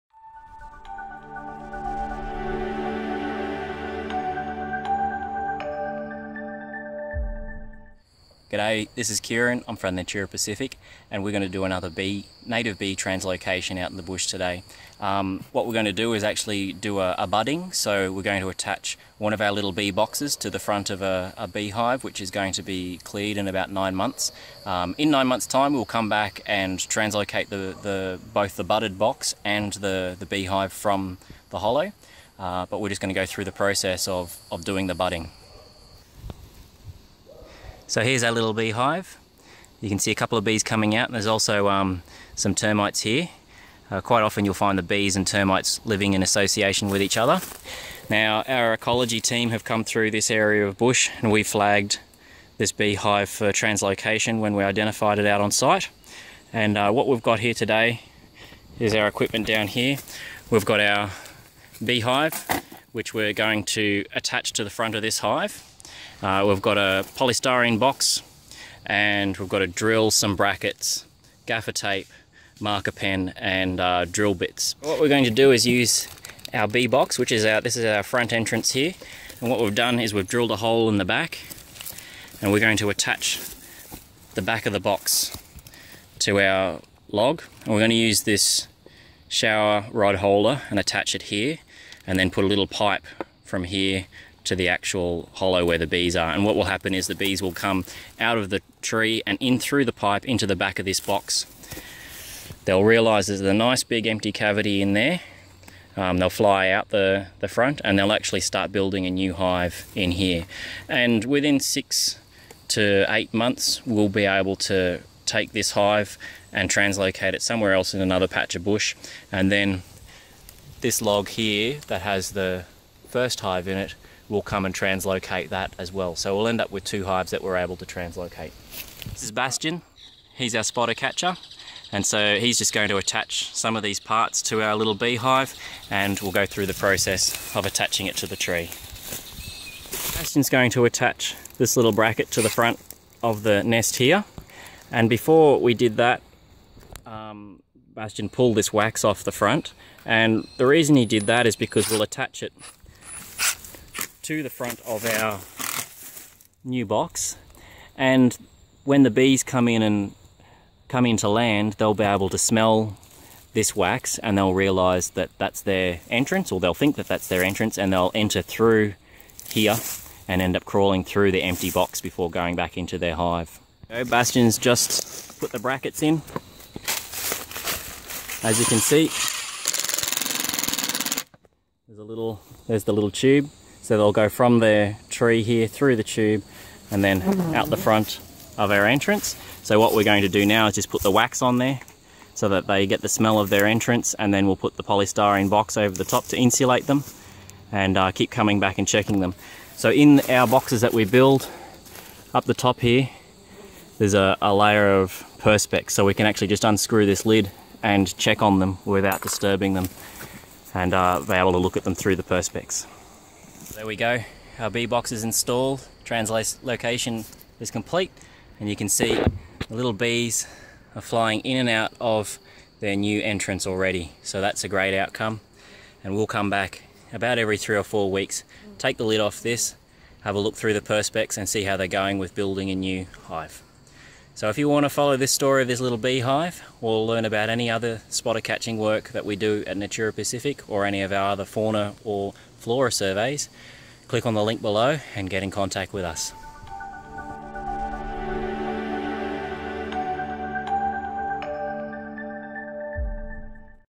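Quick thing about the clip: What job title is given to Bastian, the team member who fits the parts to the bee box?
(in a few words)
spotter catcher.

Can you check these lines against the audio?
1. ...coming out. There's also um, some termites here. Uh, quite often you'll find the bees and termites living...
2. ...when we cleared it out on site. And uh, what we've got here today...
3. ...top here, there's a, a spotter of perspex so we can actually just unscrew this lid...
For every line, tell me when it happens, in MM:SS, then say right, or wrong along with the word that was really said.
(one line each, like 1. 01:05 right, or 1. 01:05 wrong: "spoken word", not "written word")
1. 00:40 right
2. 00:54 wrong: "identified", not "cleared"
3. 03:22 wrong: "layer", not "spotter".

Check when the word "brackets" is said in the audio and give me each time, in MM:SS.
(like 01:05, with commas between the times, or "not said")
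01:10, 02:21, 02:55.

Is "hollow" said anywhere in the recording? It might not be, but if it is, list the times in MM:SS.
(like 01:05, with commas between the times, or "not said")
00:31, 01:35.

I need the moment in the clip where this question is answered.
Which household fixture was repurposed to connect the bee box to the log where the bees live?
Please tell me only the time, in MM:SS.
01:29.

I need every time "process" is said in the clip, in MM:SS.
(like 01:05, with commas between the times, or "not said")
00:33, 02:16.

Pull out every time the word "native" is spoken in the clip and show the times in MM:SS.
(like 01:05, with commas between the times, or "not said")
00:12.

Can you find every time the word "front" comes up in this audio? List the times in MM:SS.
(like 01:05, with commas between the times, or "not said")
00:20, 01:04, 01:18, 01:47, 02:22, 02:29, 02:34, 03:07.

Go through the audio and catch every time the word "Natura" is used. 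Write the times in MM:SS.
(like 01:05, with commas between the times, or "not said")
00:09, 03:59.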